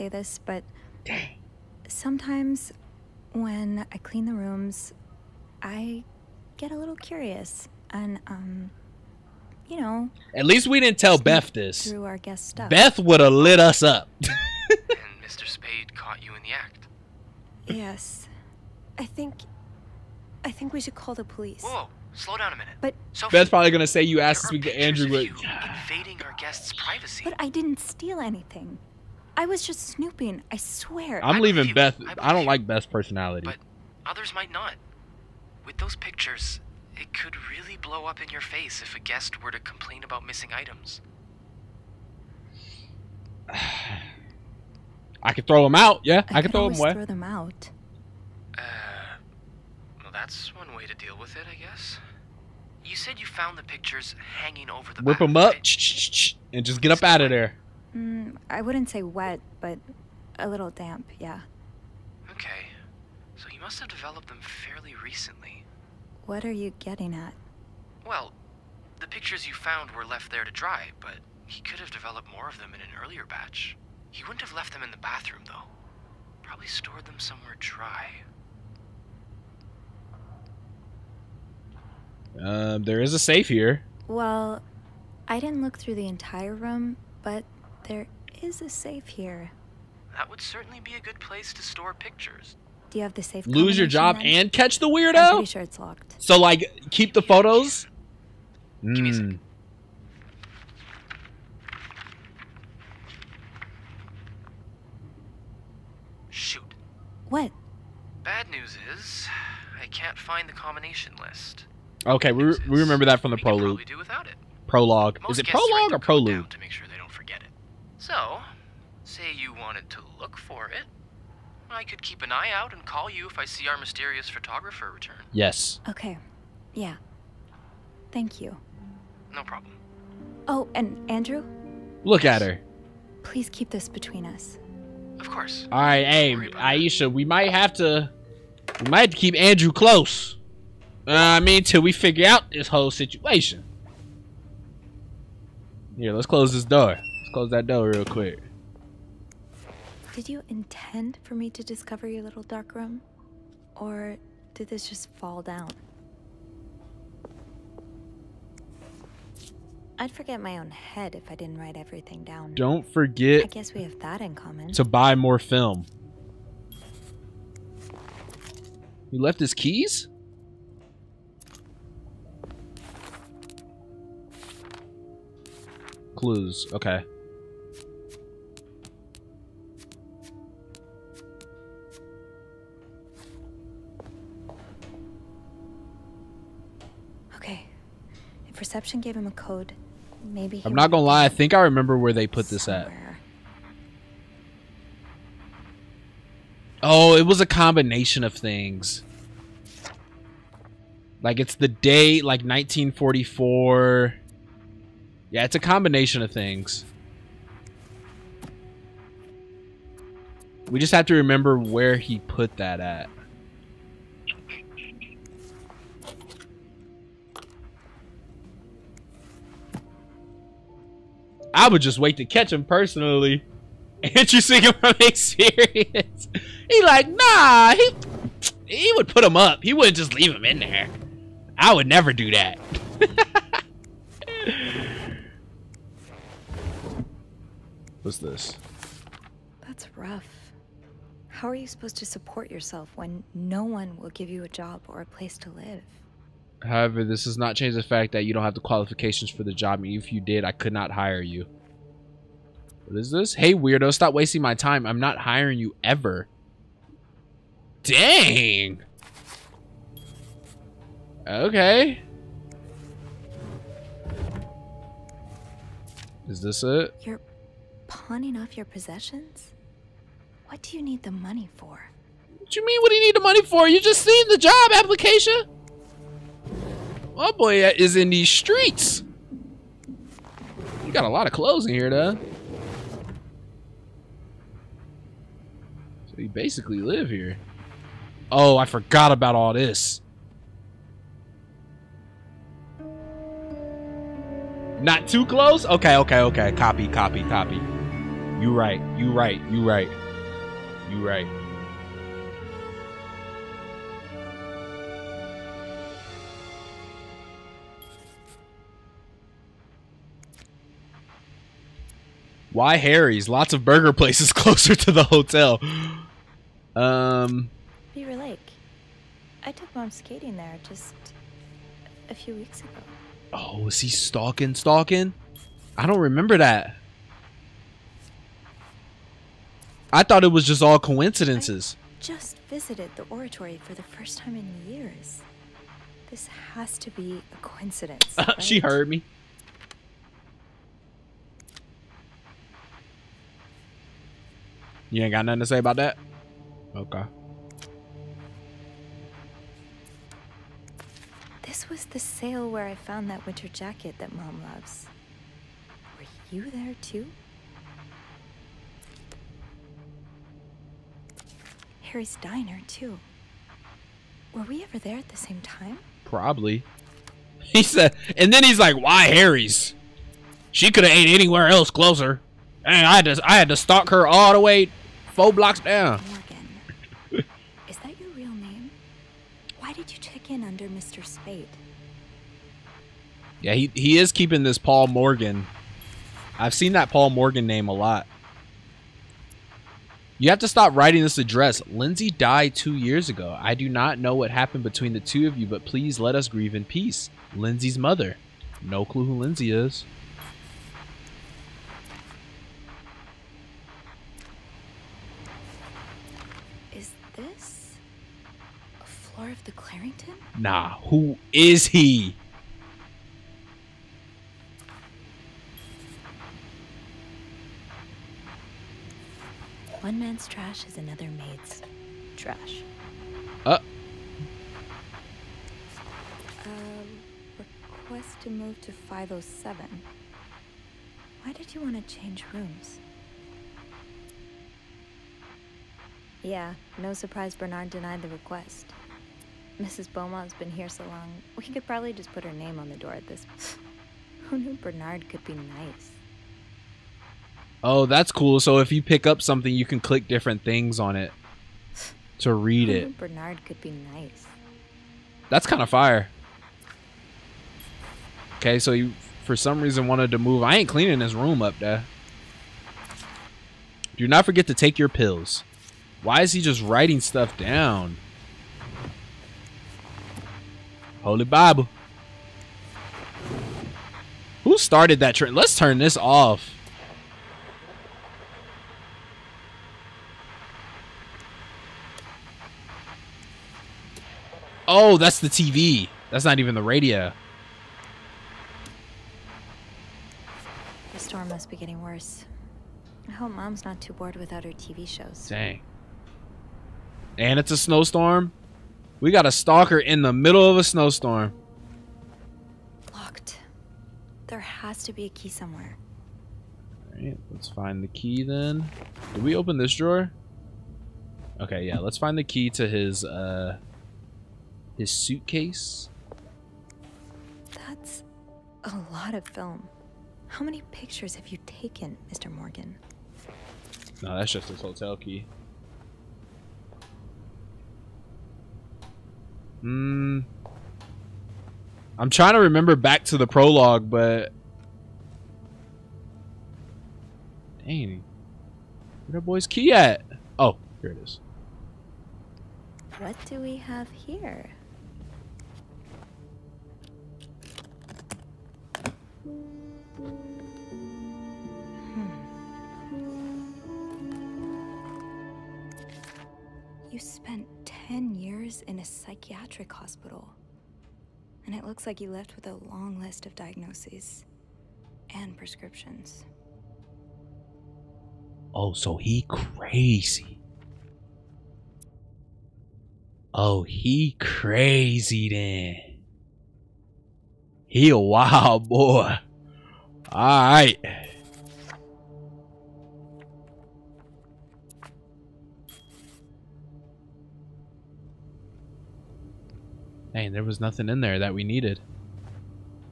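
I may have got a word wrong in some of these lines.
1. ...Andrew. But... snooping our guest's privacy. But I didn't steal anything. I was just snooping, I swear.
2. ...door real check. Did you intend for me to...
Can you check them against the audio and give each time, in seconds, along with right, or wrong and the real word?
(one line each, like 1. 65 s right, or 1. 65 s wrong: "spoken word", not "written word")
1. 24 s wrong: "invading", not "snooping"
2. 147 s wrong: "quick", not "check".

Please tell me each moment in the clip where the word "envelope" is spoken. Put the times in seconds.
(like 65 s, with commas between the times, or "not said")
not said.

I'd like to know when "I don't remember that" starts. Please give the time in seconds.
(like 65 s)
325 s.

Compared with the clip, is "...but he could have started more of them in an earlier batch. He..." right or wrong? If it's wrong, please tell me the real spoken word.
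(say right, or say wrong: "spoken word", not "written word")
wrong: "developed", not "started".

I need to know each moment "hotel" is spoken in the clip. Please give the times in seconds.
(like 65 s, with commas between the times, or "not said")
315 s, 524 s.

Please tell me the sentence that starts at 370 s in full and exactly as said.
She could have ate anywhere else closer.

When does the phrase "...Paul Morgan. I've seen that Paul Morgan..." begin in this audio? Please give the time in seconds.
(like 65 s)
384 s.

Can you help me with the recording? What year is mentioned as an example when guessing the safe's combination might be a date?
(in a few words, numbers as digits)
1944.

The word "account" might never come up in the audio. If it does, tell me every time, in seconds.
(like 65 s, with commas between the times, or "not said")
not said.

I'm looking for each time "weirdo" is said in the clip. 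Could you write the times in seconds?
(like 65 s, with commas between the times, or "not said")
94 s, 253 s.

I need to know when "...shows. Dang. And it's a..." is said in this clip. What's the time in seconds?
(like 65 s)
494 s.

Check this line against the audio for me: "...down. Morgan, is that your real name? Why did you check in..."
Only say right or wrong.
right.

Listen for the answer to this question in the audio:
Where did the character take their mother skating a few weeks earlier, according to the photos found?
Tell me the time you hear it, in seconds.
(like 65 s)
317 s.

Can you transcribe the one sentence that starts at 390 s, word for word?
You have to stop writing this address.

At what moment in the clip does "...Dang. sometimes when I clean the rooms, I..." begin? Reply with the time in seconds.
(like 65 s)
1 s.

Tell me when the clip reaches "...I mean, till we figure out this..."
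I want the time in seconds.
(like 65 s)
141 s.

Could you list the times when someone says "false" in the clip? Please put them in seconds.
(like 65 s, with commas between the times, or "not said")
not said.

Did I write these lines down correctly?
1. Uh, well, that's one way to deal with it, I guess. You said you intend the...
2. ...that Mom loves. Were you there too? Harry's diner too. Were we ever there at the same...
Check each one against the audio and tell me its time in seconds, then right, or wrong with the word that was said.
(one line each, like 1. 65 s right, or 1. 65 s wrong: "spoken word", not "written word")
1. 48 s wrong: "found", not "intend"
2. 353 s right.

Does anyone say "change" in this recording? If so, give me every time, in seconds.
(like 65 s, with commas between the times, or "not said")
247 s, 431 s.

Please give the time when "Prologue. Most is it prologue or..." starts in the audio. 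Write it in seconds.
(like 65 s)
114 s.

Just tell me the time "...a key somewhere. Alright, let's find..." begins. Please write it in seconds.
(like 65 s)
505 s.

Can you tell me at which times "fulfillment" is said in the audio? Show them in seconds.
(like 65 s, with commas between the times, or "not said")
not said.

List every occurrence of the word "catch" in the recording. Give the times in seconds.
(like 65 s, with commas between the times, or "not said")
94 s, 222 s.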